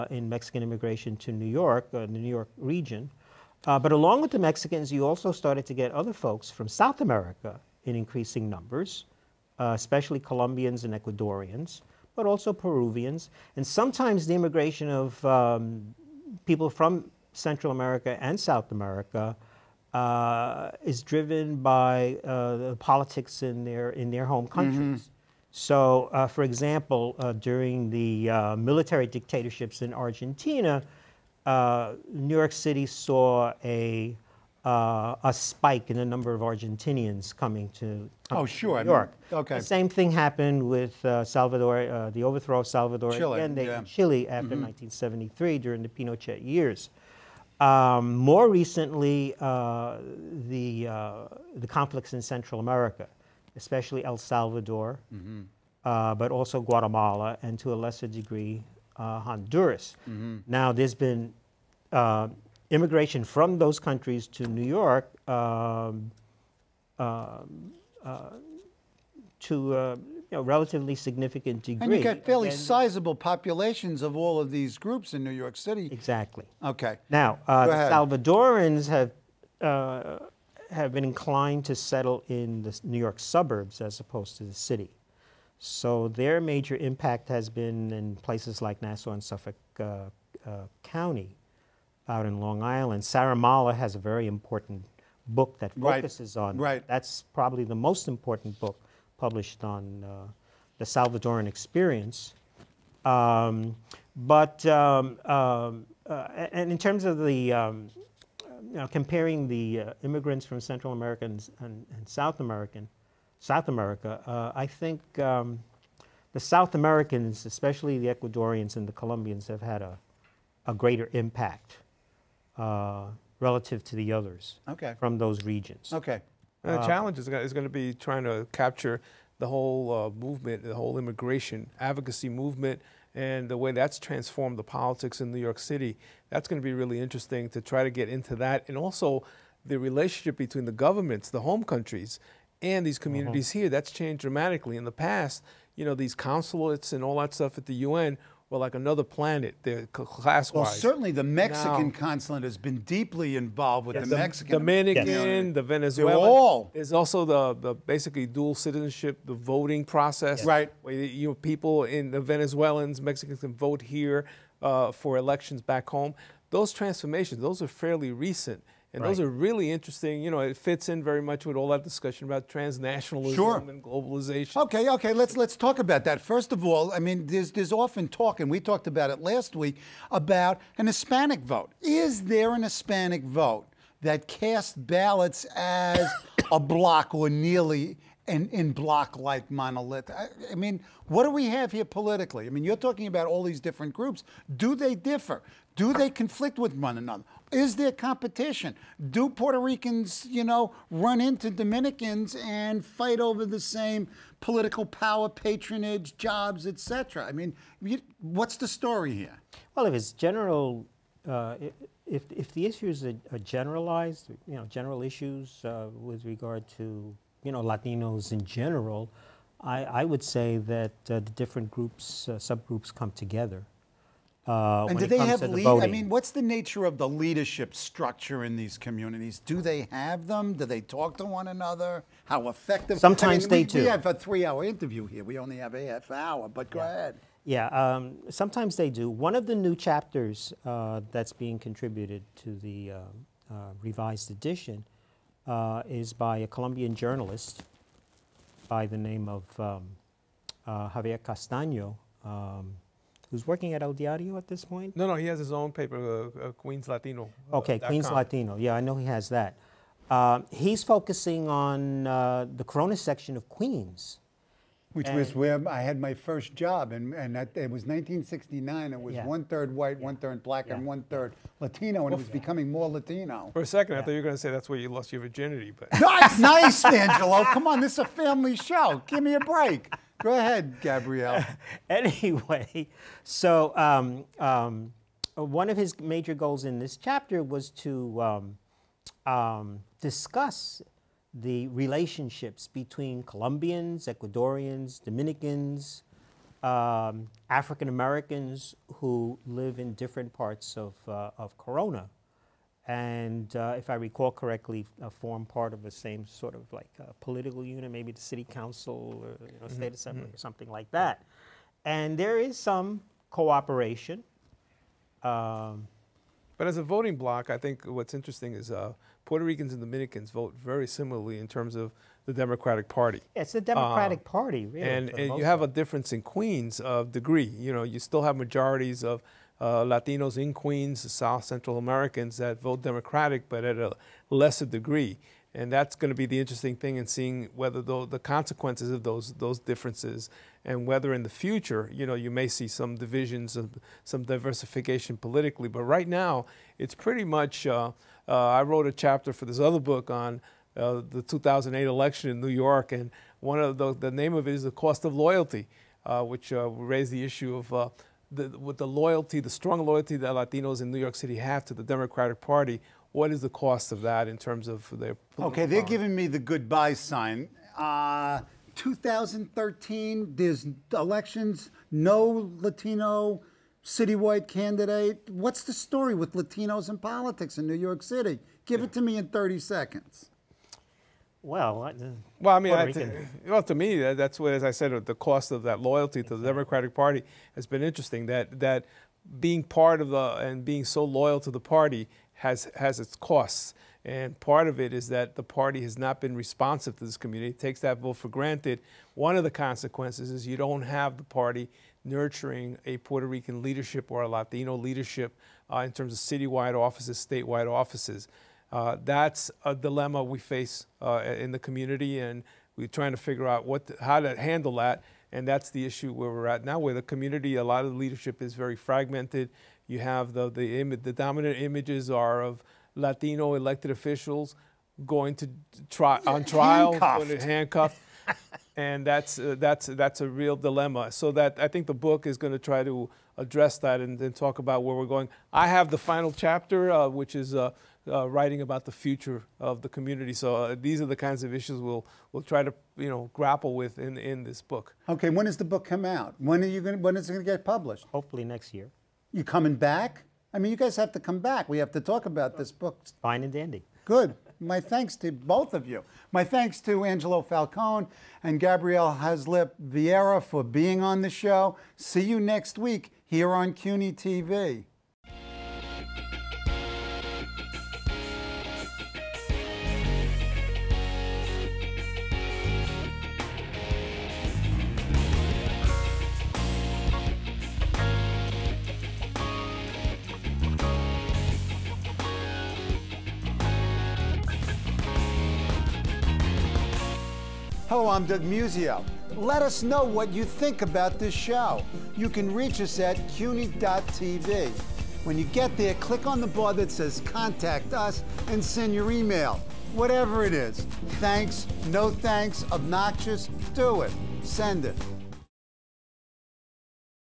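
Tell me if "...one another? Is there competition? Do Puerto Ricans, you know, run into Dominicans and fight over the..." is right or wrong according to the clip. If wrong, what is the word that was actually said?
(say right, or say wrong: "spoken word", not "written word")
right.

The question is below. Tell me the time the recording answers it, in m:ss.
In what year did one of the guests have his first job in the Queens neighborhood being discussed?
4:27.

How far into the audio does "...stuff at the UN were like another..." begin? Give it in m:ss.
2:27.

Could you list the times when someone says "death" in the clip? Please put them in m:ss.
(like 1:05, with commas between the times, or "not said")
not said.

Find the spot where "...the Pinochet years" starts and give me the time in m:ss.
0:45.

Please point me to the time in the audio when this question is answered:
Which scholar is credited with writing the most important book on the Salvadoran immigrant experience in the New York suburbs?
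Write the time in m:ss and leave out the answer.
1:33.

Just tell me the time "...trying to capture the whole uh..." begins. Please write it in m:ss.
2:07.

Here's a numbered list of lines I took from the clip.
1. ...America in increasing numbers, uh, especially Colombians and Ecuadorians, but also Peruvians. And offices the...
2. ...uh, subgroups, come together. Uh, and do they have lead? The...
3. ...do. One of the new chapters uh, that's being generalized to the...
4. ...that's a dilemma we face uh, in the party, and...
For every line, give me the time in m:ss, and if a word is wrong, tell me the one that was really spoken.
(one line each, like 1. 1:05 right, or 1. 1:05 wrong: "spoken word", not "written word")
1. 0:06 wrong: "sometimes", not "offices"
2. 3:42 right
3. 3:58 wrong: "contributed", not "generalized"
4. 6:49 wrong: "community", not "party".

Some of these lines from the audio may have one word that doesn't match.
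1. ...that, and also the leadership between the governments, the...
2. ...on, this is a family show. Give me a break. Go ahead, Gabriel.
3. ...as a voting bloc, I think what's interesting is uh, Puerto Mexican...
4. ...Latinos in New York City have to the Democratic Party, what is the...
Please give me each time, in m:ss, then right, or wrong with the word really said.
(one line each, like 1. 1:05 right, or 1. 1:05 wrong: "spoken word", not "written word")
1. 2:18 wrong: "relationship", not "leadership"
2. 4:37 right
3. 5:16 wrong: "Ricans", not "Mexican"
4. 6:00 right.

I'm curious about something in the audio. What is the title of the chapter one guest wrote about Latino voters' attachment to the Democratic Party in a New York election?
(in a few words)
The Cost of Loyalty.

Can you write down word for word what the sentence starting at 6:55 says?
And that's the issue where we're at now, where the community, a lot of the leadership is very fragmented.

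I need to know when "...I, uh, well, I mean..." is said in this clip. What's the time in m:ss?
6:21.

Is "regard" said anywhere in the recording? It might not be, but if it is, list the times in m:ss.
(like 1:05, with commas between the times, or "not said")
3:36.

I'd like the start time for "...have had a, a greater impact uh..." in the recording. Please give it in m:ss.
1:59.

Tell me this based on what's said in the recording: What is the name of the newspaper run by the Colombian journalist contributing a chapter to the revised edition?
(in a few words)
Queens Latino.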